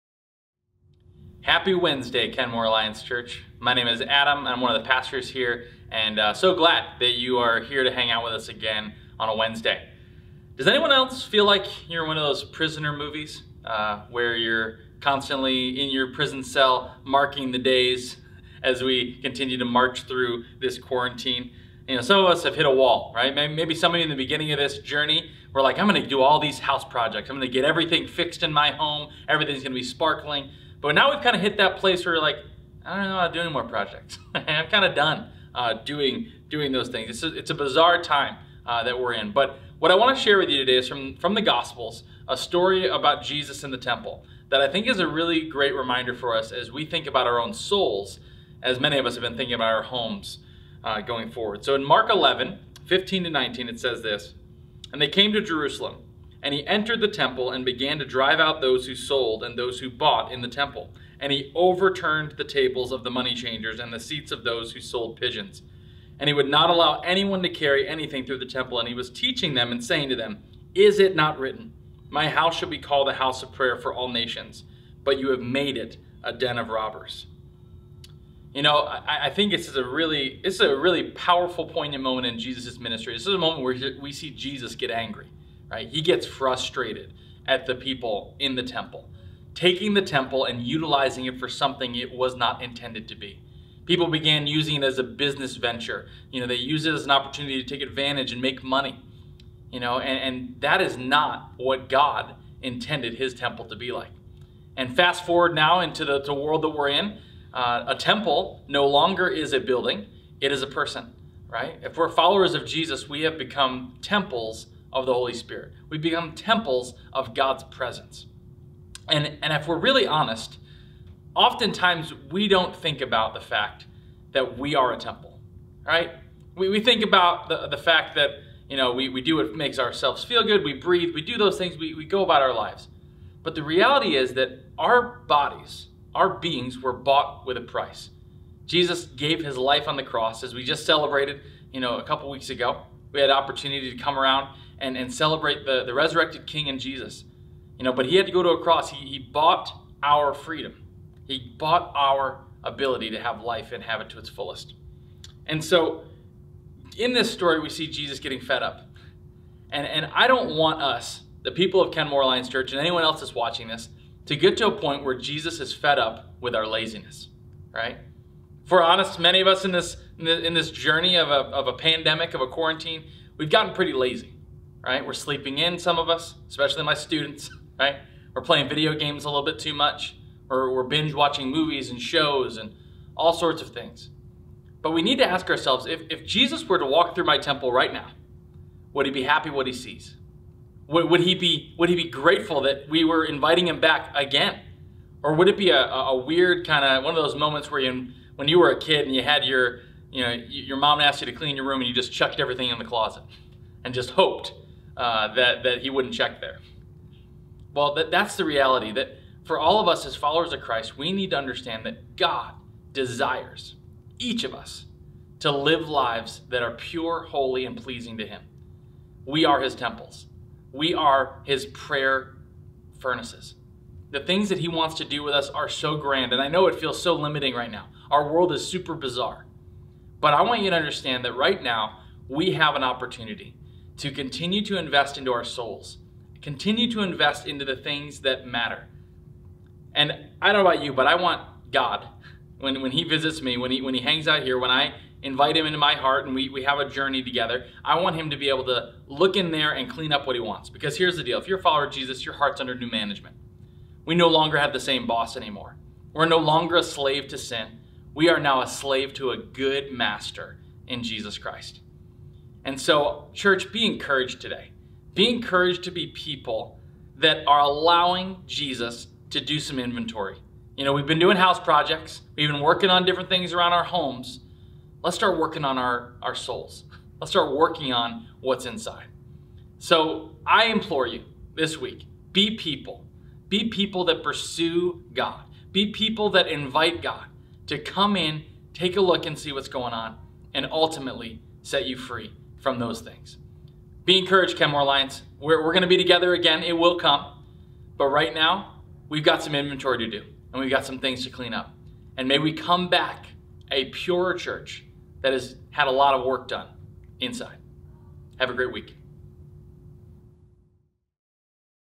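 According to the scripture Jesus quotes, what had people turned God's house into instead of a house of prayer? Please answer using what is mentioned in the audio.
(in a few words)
a den of robbers.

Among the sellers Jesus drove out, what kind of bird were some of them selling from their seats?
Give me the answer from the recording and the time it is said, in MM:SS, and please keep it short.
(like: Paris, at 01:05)
pigeons, at 01:05.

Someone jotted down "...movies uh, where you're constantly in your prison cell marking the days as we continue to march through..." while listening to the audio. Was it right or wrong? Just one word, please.
right.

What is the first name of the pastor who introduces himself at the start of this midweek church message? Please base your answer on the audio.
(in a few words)
Adam.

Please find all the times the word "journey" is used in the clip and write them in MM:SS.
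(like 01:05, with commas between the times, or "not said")
00:24, 02:50, 04:06.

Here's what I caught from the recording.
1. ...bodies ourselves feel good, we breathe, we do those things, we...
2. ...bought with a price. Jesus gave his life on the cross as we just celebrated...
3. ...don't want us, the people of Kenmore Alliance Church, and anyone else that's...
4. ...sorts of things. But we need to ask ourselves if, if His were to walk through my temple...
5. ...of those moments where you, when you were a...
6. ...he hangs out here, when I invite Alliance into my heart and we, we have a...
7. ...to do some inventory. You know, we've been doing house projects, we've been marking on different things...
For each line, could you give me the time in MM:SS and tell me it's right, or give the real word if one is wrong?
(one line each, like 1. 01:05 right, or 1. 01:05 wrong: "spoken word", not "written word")
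1. 02:09 wrong: "makes", not "bodies"
2. 02:16 right
3. 02:40 right
4. 03:03 wrong: "Jesus", not "His"
5. 03:17 right
6. 04:03 wrong: "Him", not "Alliance"
7. 04:29 wrong: "working", not "marking".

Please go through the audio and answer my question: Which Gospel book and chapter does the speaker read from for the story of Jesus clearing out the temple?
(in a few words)
Mark 11.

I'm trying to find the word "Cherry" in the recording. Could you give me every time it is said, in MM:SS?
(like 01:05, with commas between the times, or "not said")
not said.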